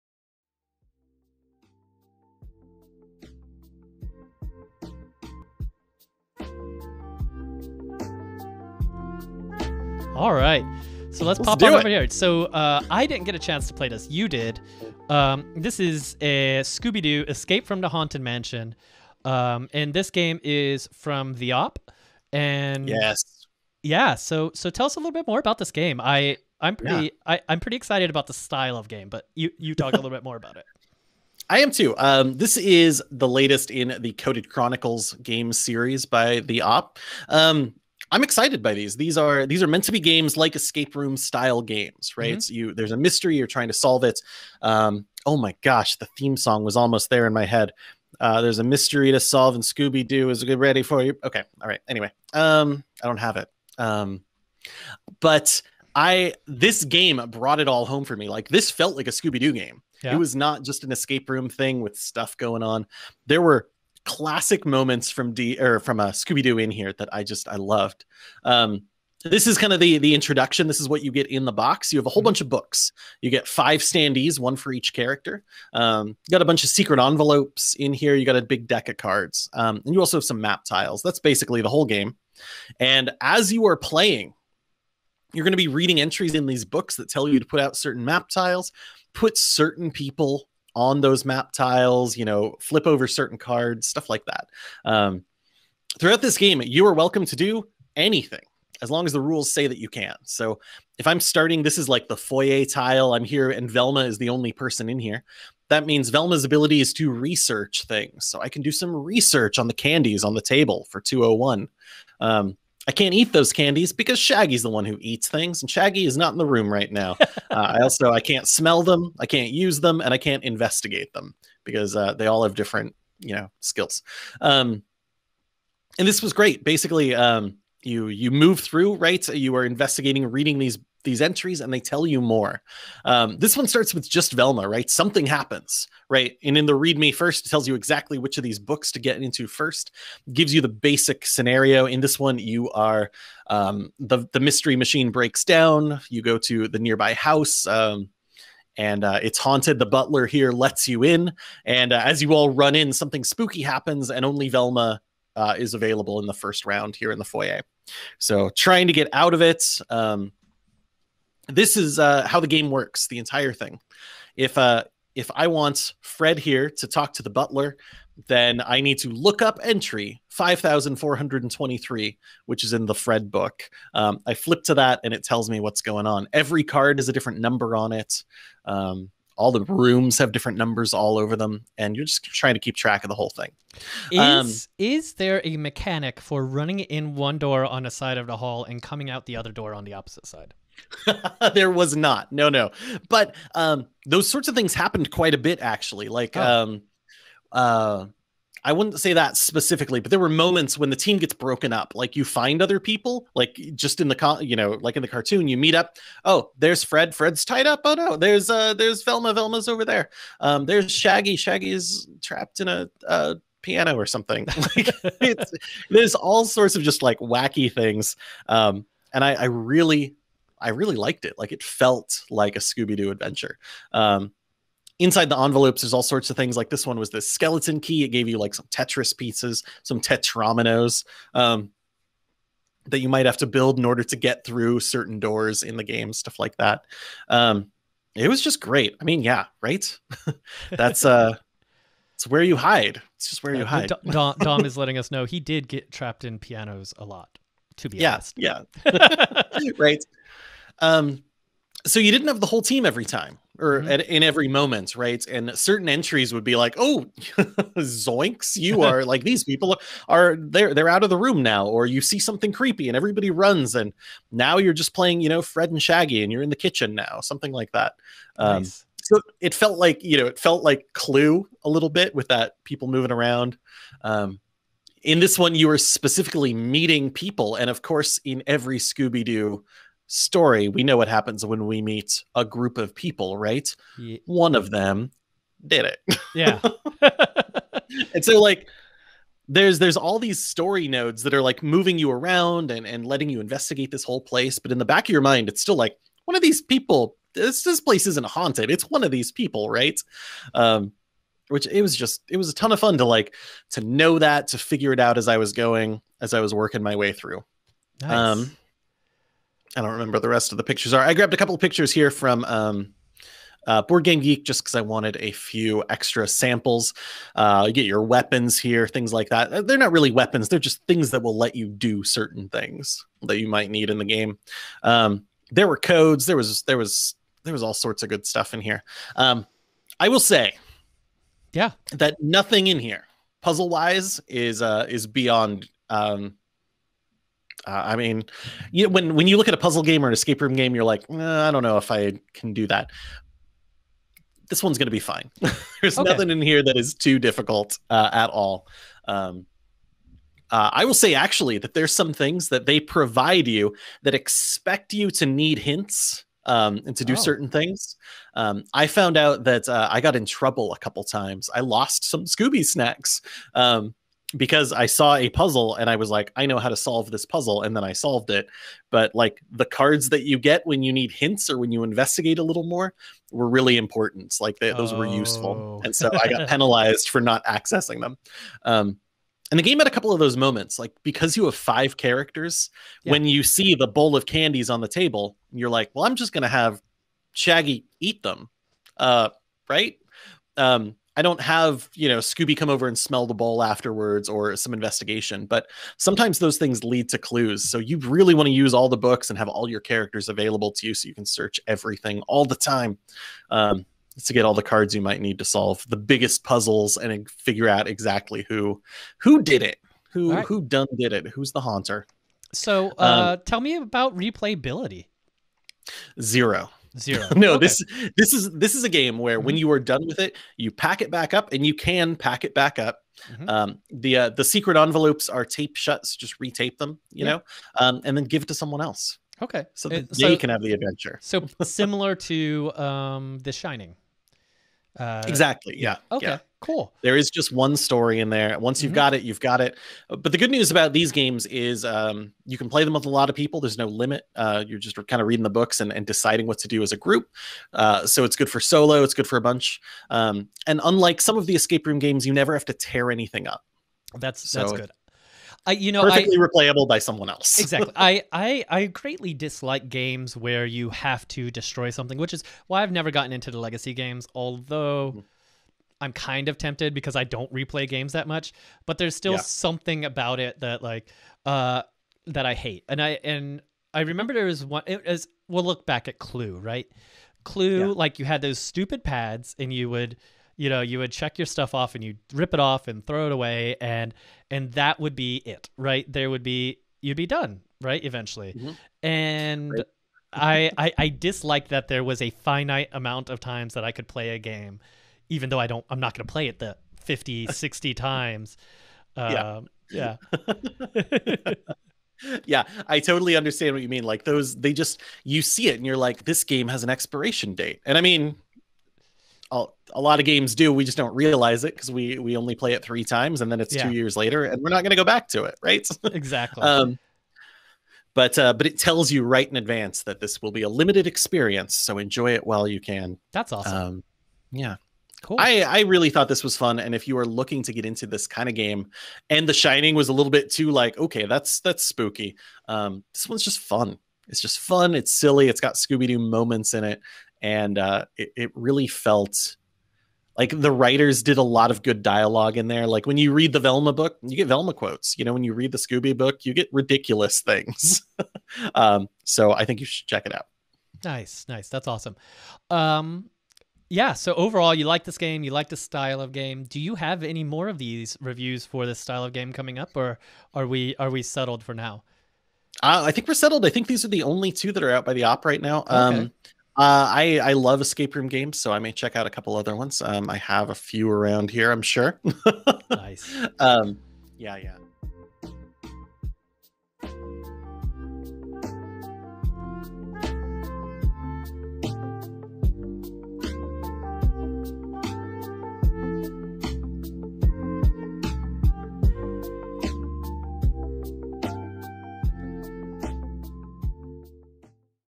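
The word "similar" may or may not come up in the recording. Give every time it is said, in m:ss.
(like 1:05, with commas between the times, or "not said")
7:11.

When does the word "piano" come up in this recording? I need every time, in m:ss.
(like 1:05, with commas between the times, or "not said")
3:33, 4:06.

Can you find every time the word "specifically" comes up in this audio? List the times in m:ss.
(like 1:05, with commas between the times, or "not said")
3:19, 4:35.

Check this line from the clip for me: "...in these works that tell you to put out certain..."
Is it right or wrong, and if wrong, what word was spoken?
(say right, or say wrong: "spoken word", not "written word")
wrong: "books", not "works".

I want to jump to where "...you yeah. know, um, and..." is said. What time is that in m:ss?
7:07.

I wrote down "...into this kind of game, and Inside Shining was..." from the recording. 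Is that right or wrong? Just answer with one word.
wrong.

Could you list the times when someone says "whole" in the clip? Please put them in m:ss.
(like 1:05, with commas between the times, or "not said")
1:12, 1:21, 3:03, 4:12, 4:54.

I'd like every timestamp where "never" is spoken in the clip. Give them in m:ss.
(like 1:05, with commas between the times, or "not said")
7:32, 7:42.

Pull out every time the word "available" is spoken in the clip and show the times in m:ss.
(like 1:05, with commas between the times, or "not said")
2:35, 6:40.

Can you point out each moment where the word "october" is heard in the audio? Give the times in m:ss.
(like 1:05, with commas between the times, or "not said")
not said.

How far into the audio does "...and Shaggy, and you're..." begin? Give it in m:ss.
4:25.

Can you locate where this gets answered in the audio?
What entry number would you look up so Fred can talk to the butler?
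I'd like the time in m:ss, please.
2:50.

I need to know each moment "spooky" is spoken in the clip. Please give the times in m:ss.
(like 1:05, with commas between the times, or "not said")
2:33, 8:51.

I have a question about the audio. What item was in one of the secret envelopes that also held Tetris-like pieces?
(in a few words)
skeleton key.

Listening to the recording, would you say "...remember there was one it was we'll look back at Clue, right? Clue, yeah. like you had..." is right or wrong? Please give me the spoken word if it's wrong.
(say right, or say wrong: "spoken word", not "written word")
right.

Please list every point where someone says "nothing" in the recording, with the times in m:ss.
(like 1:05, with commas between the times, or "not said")
5:32, 5:46.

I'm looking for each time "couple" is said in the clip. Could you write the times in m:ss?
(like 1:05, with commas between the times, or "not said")
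5:11, 6:00, 6:19, 9:29.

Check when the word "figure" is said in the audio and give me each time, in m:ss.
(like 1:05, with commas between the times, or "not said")
5:04, 6:47.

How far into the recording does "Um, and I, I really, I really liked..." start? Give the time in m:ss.
3:38.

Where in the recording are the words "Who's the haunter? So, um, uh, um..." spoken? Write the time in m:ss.
6:51.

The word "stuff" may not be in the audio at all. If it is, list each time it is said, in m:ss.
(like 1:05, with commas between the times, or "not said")
1:01, 1:33, 3:56, 5:28, 8:01.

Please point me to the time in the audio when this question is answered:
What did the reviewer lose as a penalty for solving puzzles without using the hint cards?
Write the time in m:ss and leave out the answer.
6:02.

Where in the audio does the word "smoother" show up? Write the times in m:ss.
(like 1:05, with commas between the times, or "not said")
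not said.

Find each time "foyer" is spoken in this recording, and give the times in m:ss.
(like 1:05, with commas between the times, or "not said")
1:42, 2:37.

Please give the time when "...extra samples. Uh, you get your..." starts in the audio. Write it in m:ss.
5:15.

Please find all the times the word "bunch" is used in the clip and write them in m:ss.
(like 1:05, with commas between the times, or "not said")
1:12, 1:16, 7:29.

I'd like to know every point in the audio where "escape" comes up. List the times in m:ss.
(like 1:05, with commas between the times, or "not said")
0:17, 0:40, 1:00, 5:40, 7:31, 9:27.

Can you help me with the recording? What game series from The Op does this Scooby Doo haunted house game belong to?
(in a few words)
Coded Chronicles.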